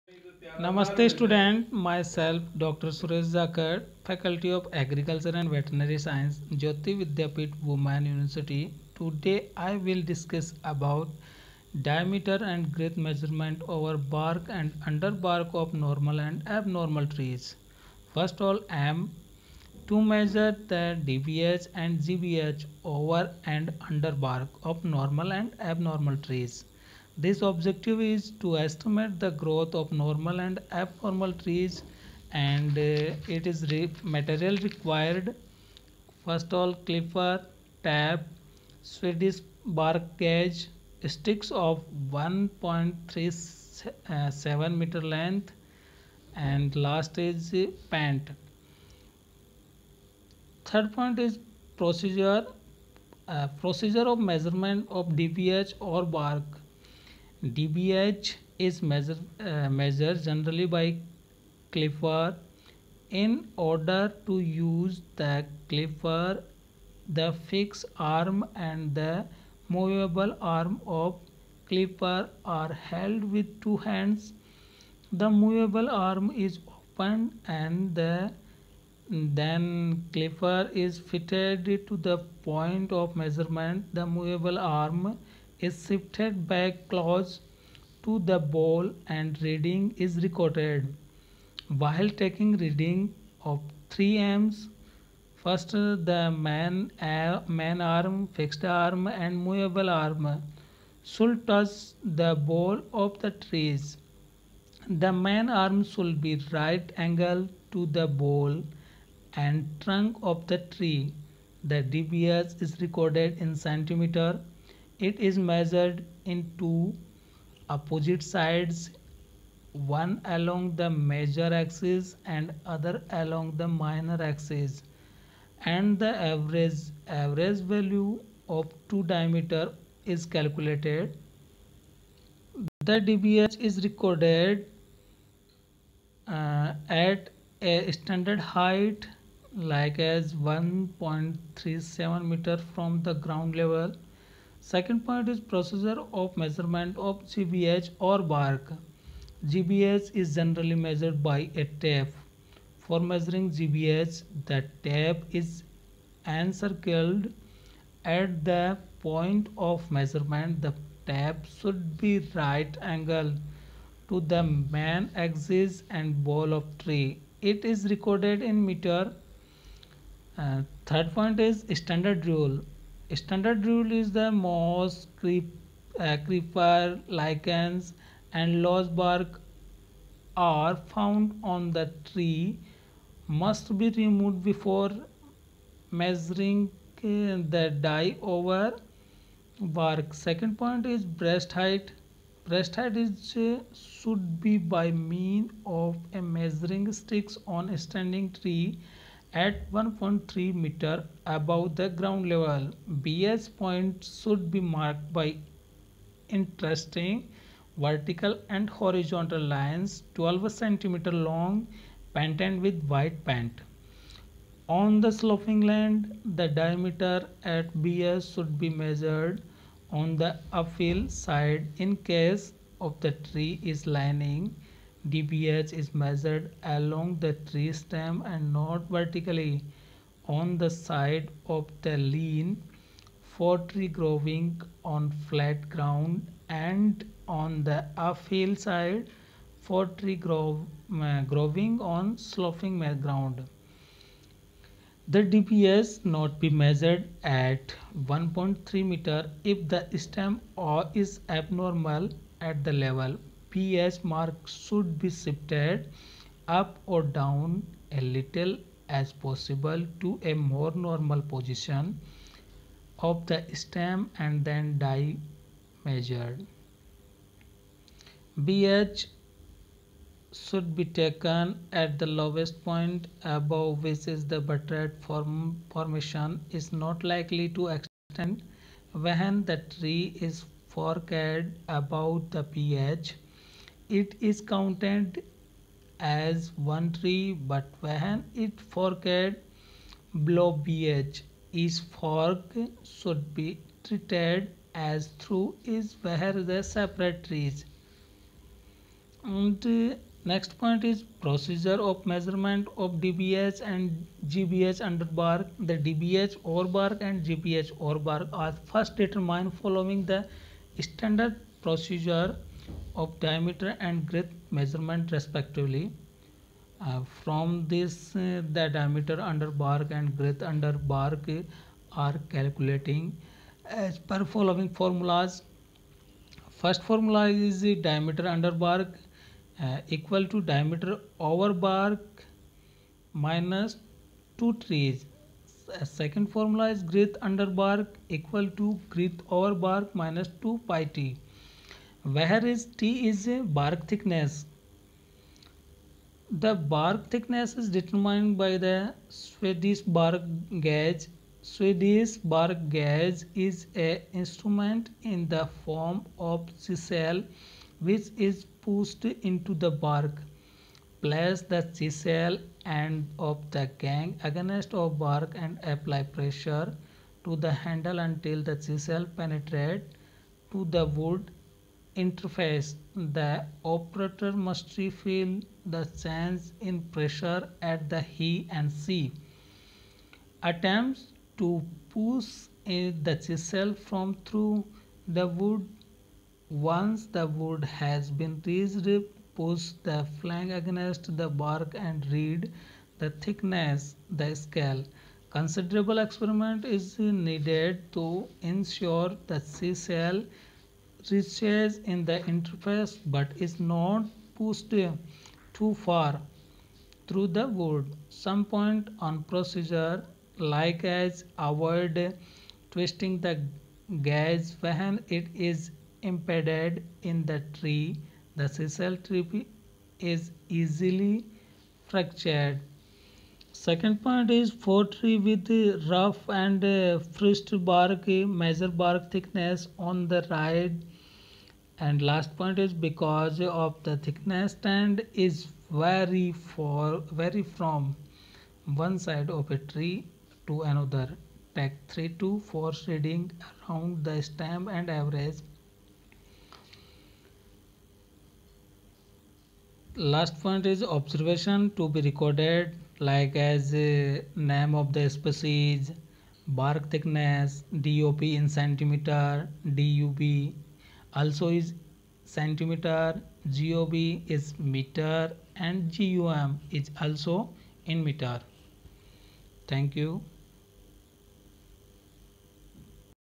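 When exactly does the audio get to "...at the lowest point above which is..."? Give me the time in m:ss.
4:31.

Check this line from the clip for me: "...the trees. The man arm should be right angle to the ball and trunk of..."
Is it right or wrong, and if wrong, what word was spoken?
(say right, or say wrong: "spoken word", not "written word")
right.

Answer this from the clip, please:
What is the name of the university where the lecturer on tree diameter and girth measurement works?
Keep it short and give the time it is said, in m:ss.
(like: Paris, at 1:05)
Jayoti Vidyapeeth Women University, at 0:06.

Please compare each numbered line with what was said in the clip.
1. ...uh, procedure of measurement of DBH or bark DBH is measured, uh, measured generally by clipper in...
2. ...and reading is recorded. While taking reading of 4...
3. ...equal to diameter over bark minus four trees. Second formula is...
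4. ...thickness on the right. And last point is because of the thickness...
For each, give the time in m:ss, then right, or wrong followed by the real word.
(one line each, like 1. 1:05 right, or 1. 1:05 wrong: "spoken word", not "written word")
1. 0:53 right
2. 1:29 wrong: "3", not "4"
3. 5:29 wrong: "two", not "four"
4. 7:09 right.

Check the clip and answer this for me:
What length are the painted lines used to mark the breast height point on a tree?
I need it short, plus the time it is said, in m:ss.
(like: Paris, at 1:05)
12 centimeter, at 3:30.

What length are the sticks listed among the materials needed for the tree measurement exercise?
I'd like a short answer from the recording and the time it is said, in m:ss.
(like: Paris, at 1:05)
1.37 meter, at 0:42.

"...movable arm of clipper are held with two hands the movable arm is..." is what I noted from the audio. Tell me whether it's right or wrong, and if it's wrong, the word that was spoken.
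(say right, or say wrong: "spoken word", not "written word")
right.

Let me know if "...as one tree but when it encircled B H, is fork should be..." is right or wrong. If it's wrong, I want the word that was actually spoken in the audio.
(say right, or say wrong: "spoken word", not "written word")
wrong: "forked", not "encircled".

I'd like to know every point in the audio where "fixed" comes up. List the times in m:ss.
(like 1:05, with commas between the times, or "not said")
1:07, 1:38.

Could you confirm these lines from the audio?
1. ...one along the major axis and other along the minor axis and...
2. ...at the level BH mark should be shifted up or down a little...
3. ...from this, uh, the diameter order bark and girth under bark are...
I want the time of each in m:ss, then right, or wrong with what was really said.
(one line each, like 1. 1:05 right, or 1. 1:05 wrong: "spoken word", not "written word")
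1. 1:59 right
2. 4:12 right
3. 5:17 wrong: "under", not "order".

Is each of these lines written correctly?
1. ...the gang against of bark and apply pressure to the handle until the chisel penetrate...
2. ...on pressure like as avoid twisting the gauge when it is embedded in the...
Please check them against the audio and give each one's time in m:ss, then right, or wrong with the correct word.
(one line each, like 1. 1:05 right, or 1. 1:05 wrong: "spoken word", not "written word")
1. 6:03 right
2. 6:48 wrong: "procedure", not "pressure".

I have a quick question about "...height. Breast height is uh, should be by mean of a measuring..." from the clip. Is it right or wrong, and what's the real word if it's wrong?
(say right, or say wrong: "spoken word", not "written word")
right.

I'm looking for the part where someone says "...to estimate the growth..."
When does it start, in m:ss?
0:28.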